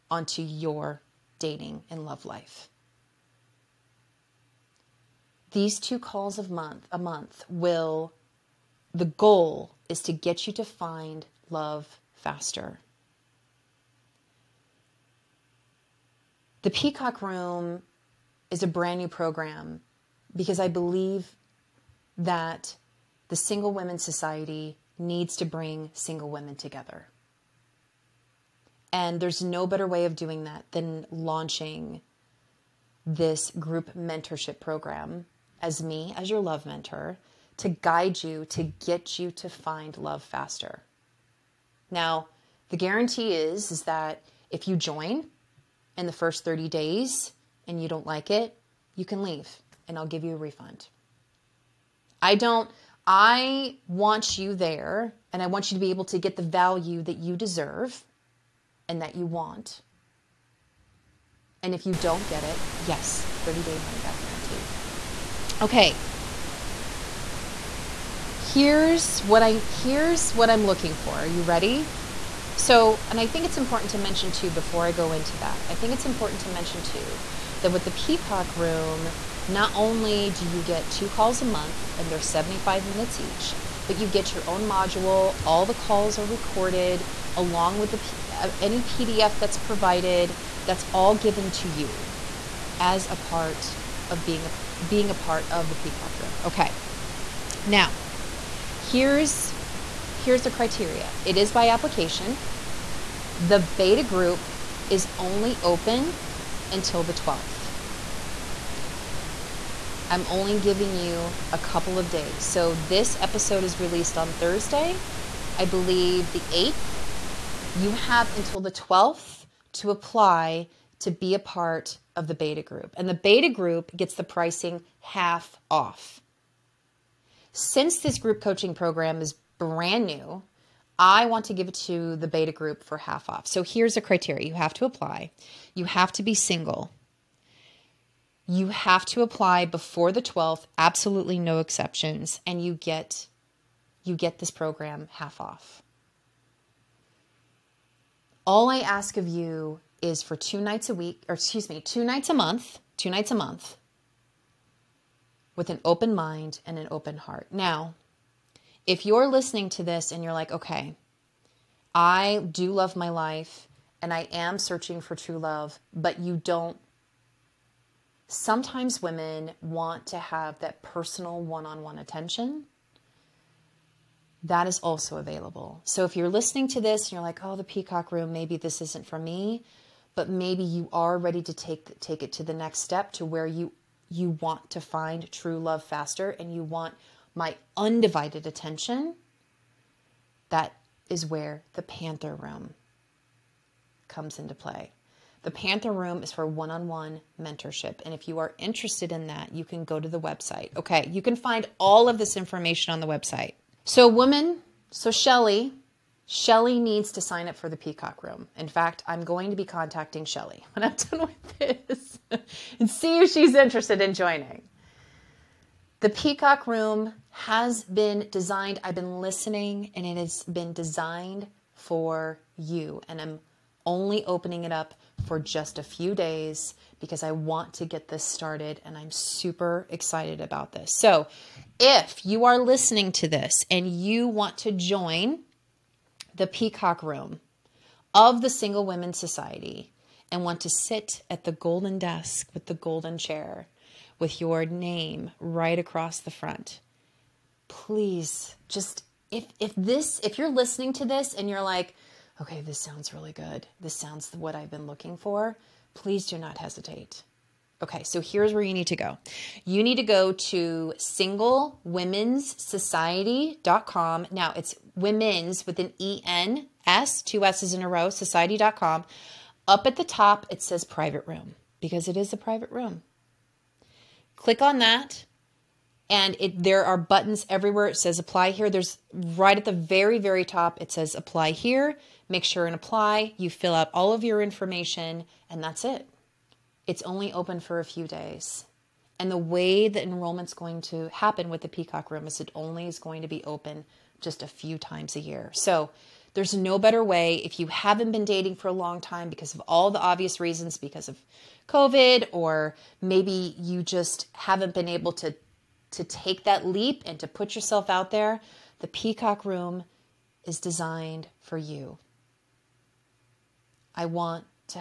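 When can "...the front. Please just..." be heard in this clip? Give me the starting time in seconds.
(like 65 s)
246 s.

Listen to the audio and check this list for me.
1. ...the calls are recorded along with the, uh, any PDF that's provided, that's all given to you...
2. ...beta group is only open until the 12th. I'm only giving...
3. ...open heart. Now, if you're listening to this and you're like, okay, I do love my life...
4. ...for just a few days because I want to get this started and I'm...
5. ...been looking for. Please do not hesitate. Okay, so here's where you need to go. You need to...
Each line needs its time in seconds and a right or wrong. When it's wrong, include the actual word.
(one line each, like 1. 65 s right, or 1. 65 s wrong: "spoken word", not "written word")
1. 85 s right
2. 103 s right
3. 156 s right
4. 225 s right
5. 254 s right.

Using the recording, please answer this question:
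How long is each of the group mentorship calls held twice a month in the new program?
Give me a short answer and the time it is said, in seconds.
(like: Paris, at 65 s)
75 minutes, at 82 s.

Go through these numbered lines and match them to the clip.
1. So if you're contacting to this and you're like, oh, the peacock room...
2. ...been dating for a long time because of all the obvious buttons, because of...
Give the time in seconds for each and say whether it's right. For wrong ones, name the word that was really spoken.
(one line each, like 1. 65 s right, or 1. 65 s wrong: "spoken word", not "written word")
1. 175 s wrong: "listening", not "contacting"
2. 298 s wrong: "reasons", not "buttons".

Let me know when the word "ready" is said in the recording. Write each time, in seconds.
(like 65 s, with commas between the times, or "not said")
71 s, 181 s.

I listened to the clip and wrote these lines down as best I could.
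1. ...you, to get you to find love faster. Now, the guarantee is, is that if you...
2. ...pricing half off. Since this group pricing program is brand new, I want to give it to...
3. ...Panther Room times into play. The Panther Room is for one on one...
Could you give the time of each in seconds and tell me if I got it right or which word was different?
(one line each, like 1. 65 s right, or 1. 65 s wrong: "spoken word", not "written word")
1. 38 s right
2. 124 s wrong: "coaching", not "pricing"
3. 191 s wrong: "comes", not "times".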